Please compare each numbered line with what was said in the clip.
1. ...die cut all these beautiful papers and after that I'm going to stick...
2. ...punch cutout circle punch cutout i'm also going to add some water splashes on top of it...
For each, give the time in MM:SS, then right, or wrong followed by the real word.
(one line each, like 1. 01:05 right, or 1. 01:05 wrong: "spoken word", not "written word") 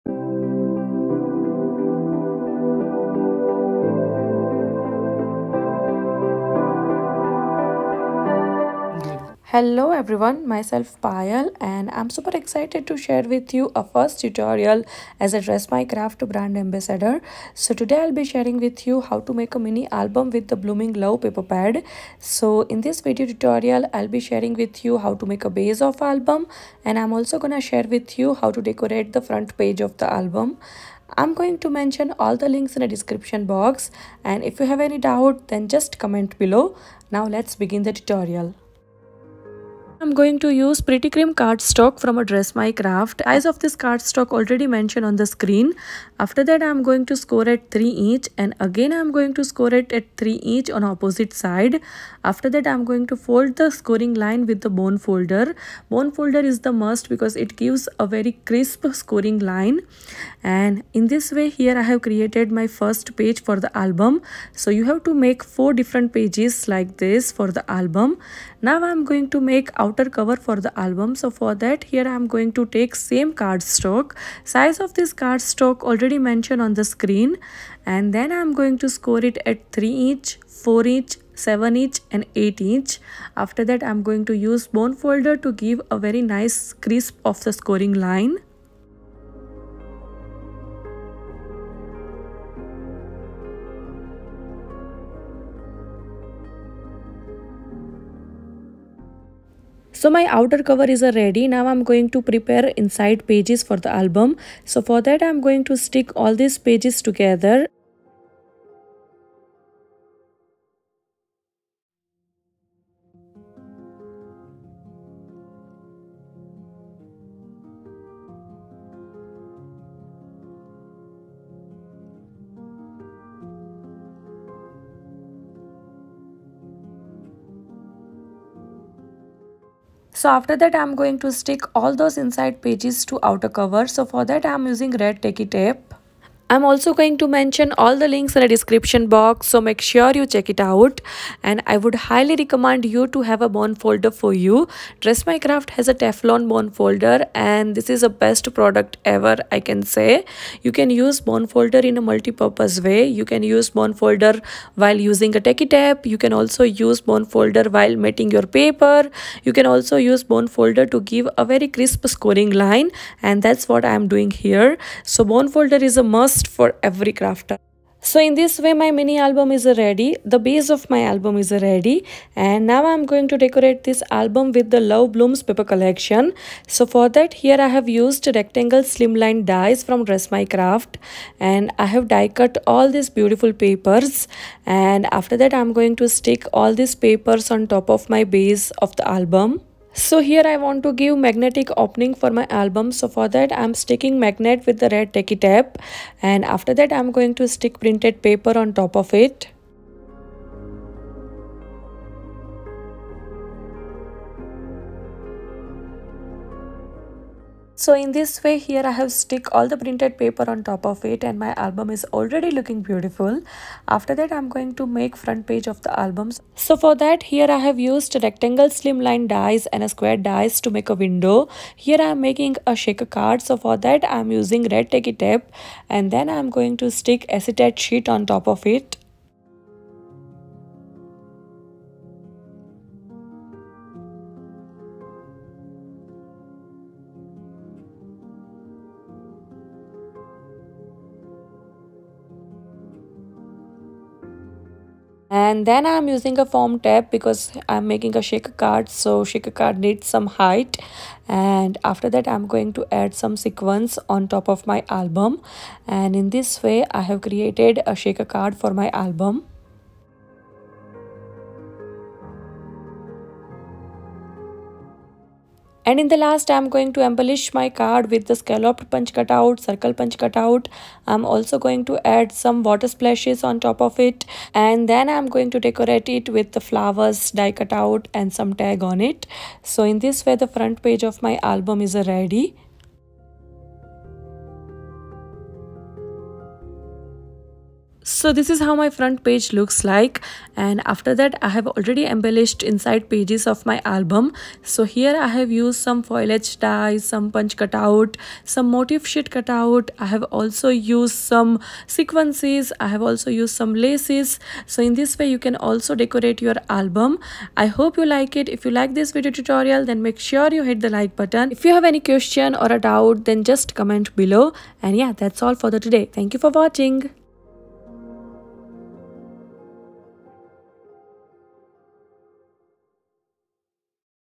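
1. 03:02 right
2. 04:28 right.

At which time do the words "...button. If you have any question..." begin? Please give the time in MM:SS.
05:11.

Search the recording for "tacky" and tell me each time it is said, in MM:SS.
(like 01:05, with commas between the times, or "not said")
02:15, 02:35, 03:15, 03:44.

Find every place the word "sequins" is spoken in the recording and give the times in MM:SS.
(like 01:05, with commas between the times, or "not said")
04:13, 05:01.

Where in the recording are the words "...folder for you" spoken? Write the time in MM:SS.
02:23.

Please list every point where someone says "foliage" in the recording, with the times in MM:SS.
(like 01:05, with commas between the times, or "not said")
04:56.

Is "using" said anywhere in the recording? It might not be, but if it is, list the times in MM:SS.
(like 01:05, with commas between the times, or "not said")
02:14, 02:34, 03:44, 04:06.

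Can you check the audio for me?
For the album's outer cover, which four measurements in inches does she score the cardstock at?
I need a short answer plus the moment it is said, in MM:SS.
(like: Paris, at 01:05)
3, 4, 7 and 8 inch, at 01:19.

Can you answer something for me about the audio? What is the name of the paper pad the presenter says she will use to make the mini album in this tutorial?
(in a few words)
Blooming Love.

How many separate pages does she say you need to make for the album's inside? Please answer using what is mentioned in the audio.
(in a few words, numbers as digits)
4.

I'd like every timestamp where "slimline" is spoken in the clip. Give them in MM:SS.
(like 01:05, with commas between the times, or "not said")
02:58, 03:38.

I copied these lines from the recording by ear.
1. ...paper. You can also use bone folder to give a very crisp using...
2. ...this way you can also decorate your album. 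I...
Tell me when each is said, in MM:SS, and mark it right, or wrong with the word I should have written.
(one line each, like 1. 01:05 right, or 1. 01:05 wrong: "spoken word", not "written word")
1. 02:38 wrong: "scoring", not "using"
2. 05:04 right.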